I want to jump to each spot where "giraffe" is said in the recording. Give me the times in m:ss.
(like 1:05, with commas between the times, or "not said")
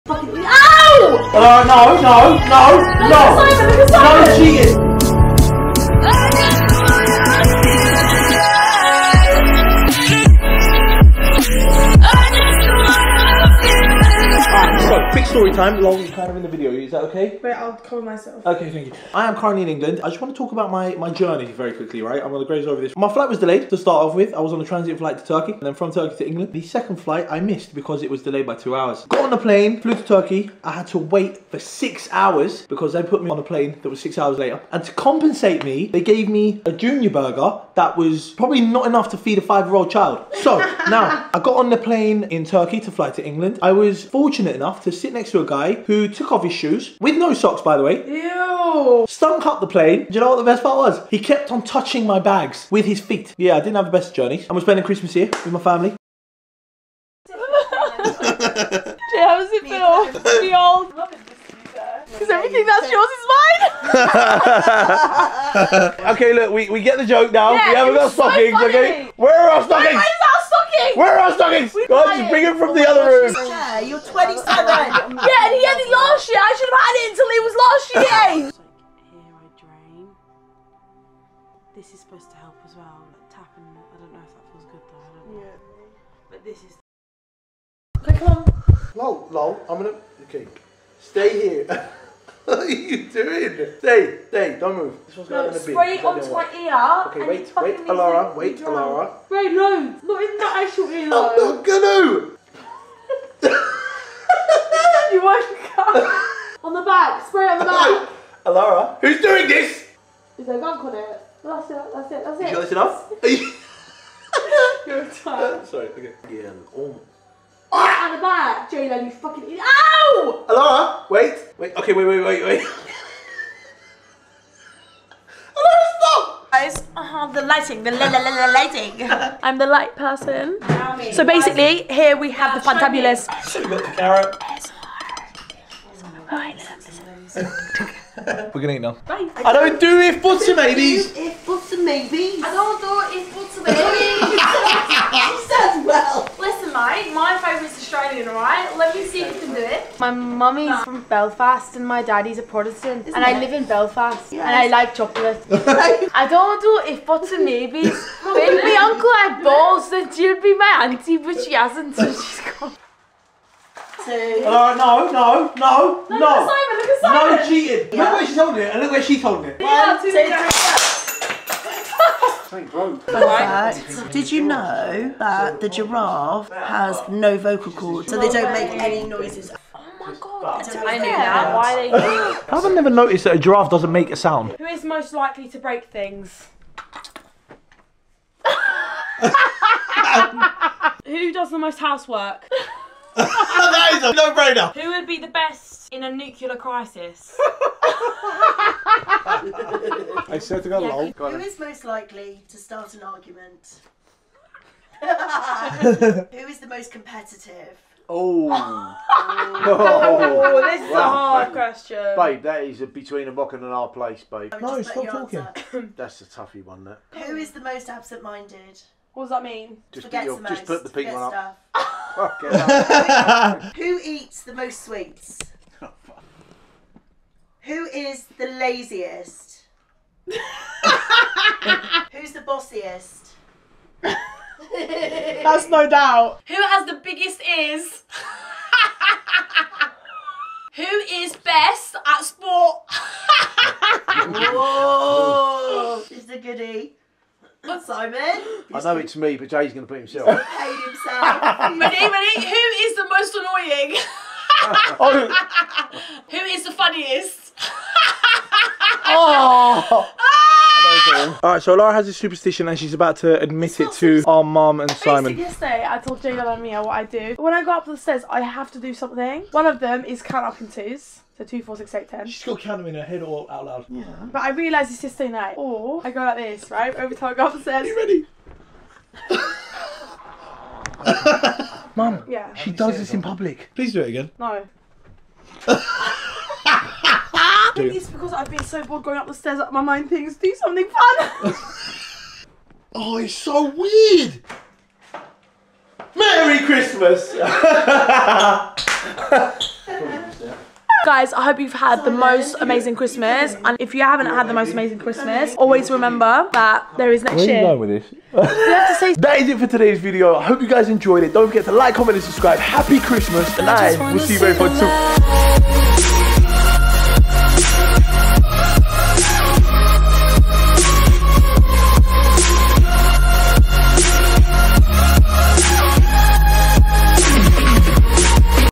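2:55, 3:03.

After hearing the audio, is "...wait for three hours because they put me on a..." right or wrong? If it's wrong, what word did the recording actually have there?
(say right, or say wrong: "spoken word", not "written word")
wrong: "six", not "three".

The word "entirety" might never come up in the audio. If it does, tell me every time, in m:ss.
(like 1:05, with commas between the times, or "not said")
not said.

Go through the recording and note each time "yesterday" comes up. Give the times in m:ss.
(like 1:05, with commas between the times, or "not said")
4:25, 4:35.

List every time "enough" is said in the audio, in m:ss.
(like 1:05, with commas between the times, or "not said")
0:38, 0:44, 1:52.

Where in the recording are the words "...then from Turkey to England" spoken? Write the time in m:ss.
0:25.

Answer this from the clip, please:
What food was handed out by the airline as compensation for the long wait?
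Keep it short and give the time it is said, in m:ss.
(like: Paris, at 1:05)
junior burger, at 0:36.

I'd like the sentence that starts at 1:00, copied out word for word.
Because everything that's yours is mine.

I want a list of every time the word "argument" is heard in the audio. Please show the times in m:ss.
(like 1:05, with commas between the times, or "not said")
3:23.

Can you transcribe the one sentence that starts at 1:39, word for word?
Wait, no, not in that actual ear.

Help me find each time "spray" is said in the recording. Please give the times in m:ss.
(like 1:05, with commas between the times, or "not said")
1:35, 1:47.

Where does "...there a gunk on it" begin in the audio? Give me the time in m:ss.
1:50.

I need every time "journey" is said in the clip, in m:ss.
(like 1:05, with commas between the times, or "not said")
0:21, 0:54.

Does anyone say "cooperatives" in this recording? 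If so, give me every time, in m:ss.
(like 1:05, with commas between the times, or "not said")
not said.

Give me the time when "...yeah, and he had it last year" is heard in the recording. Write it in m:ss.
1:14.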